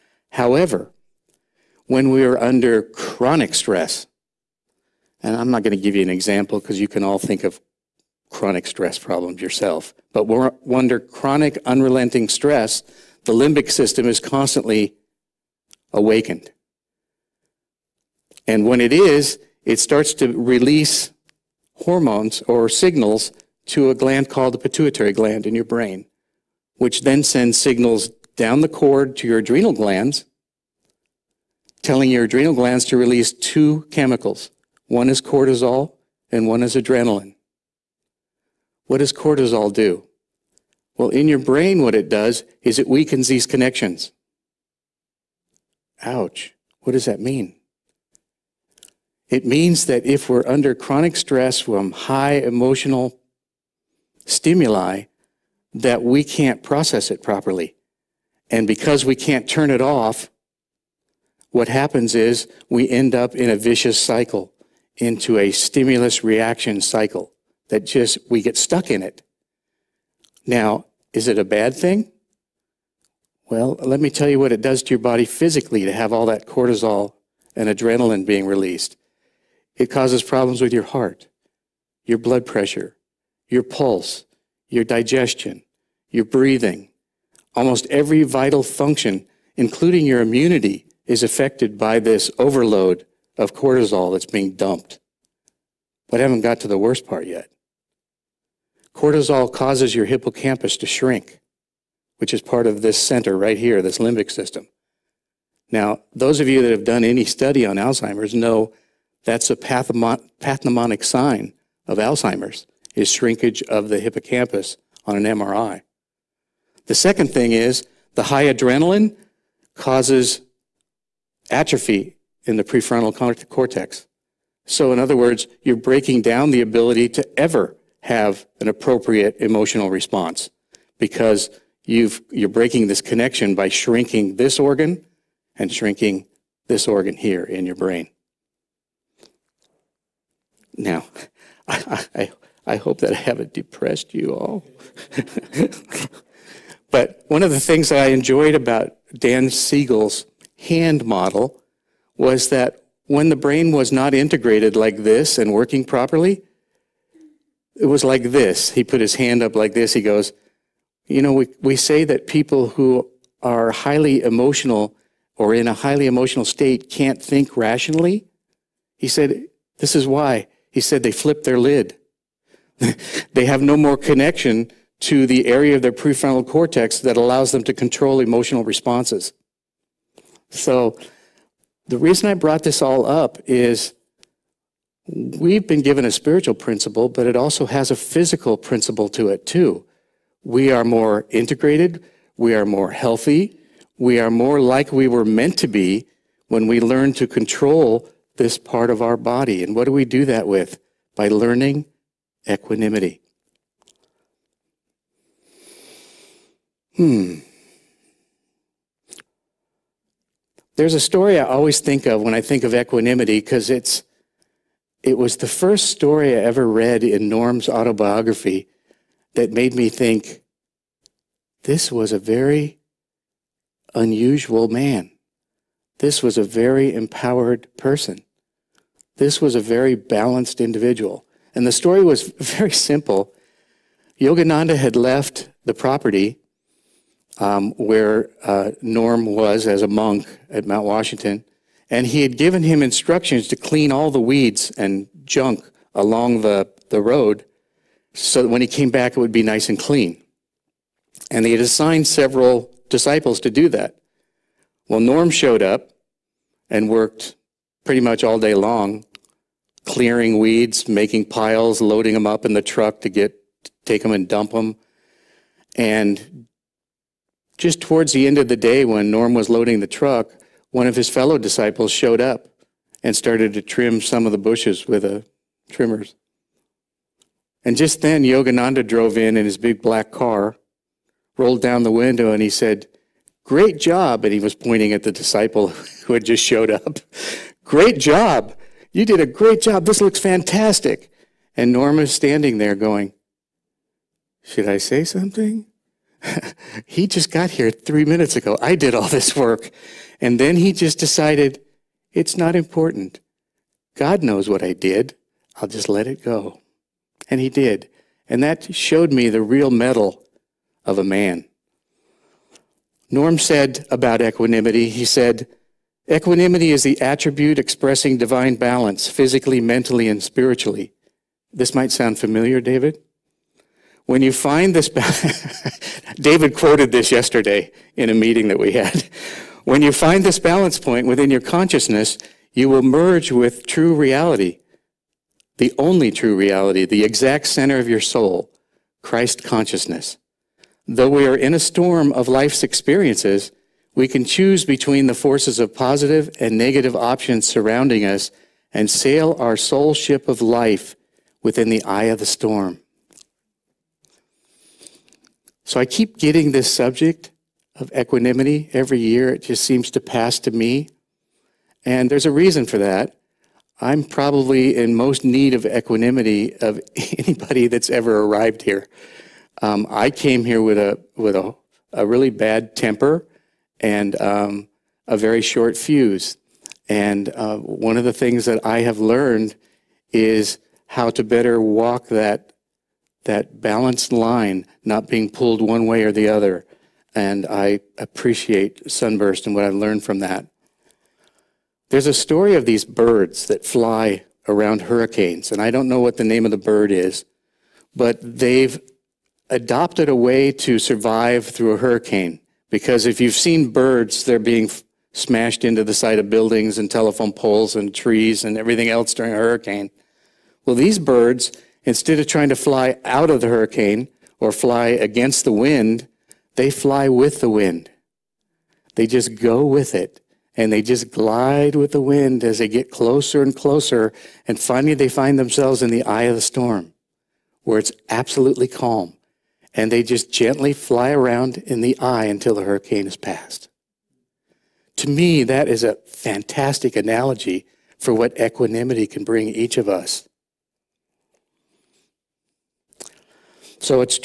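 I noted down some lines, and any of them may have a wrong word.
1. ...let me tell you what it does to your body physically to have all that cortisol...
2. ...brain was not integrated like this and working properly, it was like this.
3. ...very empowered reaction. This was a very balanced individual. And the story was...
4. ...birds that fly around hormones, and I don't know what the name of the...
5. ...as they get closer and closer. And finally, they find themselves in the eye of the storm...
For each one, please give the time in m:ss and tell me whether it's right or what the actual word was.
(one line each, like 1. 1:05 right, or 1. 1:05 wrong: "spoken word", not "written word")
1. 1:13 right
2. 2:33 right
3. 3:46 wrong: "person", not "reaction"
4. 6:32 wrong: "hurricanes", not "hormones"
5. 7:02 right.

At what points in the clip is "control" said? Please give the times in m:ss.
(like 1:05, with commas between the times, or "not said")
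2:57, 3:17.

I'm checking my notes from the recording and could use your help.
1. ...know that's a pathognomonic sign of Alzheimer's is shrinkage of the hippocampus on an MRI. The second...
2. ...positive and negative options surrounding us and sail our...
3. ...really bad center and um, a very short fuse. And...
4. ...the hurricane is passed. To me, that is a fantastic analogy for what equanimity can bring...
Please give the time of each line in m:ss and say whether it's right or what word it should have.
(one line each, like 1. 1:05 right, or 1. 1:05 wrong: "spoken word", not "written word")
1. 1:48 right
2. 5:45 right
3. 6:12 wrong: "temper", not "center"
4. 7:12 right.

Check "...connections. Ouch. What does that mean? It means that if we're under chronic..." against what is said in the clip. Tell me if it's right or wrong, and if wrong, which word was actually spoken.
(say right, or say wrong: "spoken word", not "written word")
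right.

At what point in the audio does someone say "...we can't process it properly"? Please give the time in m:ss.
0:56.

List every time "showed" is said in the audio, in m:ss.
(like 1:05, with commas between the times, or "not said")
4:15, 4:31, 4:46, 5:08.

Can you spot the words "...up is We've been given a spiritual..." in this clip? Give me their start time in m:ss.
3:03.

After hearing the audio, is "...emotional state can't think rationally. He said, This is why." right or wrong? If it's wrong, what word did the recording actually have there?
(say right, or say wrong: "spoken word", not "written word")
right.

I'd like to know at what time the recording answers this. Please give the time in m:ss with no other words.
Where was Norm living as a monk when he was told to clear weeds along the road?
4:00.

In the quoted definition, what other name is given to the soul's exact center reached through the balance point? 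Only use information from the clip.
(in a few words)
Christ consciousness.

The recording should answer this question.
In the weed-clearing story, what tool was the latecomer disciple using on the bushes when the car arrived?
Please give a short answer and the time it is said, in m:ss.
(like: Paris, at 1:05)
Trimmers, at 4:35.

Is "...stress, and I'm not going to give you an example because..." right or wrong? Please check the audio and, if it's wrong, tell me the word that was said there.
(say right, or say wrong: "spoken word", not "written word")
right.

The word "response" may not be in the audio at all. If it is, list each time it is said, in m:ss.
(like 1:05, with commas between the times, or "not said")
2:09, 2:58.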